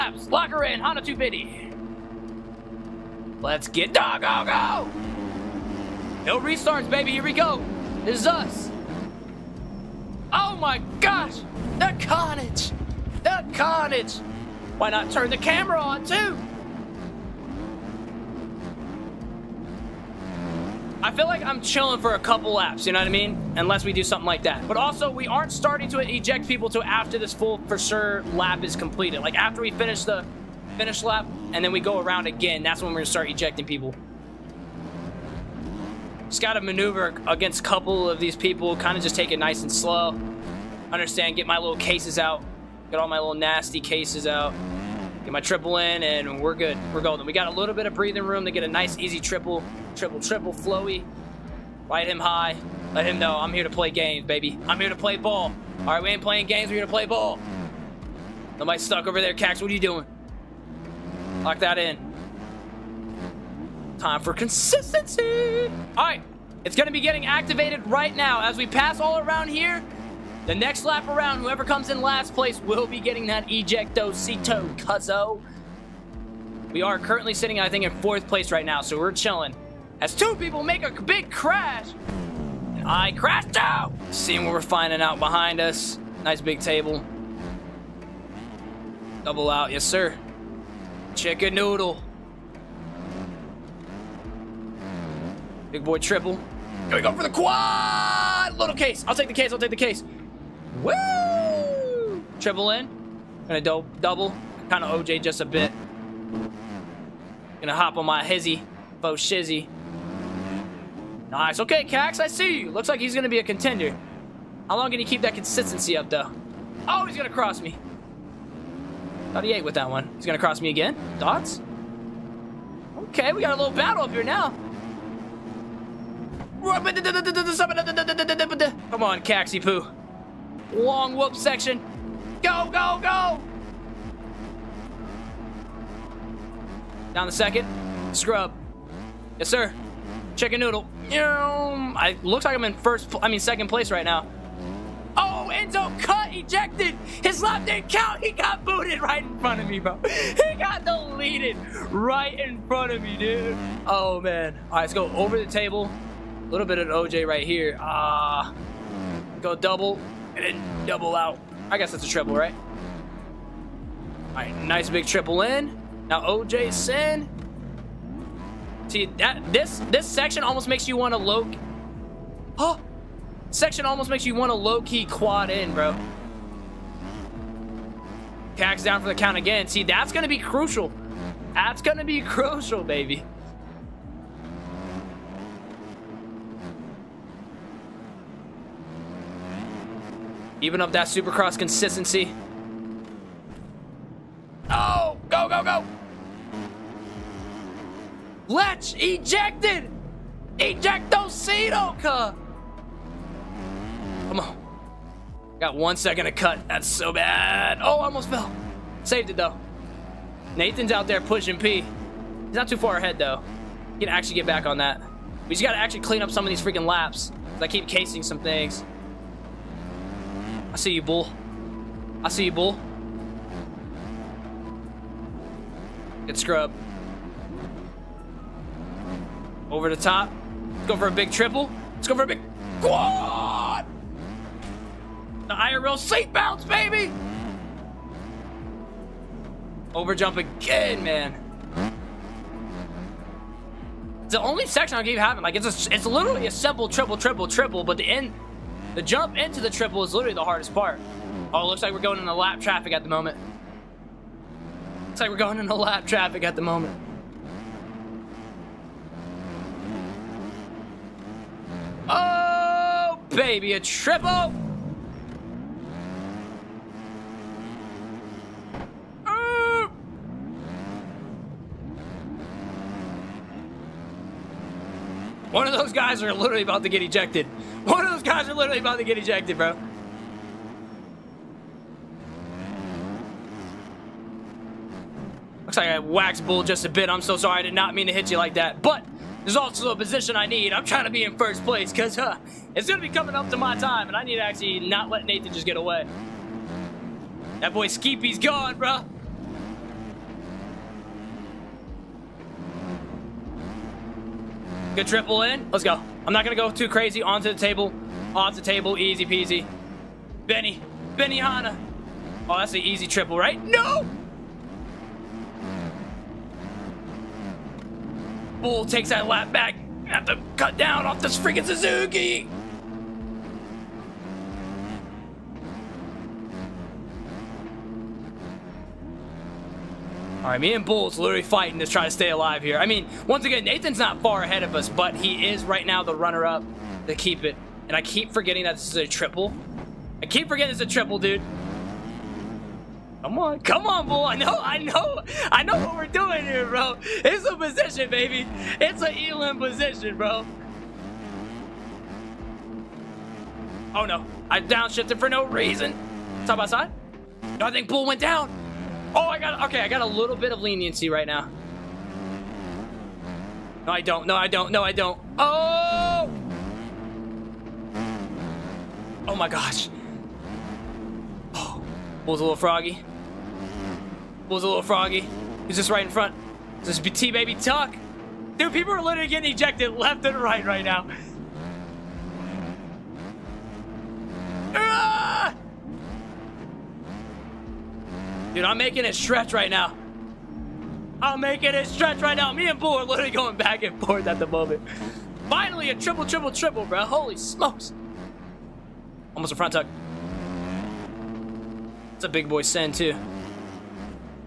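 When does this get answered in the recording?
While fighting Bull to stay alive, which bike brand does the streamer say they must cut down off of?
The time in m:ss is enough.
5:21.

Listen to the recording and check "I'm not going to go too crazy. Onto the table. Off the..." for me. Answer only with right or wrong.
right.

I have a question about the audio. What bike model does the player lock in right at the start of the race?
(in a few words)
Honda 250.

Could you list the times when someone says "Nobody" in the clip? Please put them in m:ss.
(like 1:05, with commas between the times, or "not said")
0:58.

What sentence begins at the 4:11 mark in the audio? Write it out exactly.
Oh, looks like we're going into lap traffic at the moment.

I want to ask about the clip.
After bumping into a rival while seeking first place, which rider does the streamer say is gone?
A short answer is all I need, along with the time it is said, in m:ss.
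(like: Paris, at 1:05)
Skeepy, at 4:57.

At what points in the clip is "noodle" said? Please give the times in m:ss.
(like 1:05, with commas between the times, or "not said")
1:31, 2:20.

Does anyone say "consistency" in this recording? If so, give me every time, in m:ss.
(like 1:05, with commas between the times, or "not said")
1:04, 1:55, 3:11.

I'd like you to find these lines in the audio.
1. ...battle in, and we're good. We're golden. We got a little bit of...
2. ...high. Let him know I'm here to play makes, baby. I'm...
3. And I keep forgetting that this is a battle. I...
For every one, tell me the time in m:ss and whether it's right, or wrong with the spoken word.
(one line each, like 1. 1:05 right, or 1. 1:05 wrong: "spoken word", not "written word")
1. 0:45 wrong: "triple", not "battle"
2. 0:52 wrong: "games", not "makes"
3. 5:37 wrong: "triple", not "battle".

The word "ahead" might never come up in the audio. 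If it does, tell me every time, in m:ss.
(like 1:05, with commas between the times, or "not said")
3:32, 5:34.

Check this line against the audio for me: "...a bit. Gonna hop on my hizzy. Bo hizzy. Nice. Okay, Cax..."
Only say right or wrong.
wrong.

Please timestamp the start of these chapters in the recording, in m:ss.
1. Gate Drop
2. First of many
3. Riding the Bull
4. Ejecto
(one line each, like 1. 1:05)
1. 0:06
2. 2:14
3. 3:44
4. 6:14.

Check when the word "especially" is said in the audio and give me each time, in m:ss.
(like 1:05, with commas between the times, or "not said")
not said.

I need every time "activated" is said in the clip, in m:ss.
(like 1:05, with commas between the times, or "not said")
1:07.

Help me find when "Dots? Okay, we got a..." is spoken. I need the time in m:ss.
2:01.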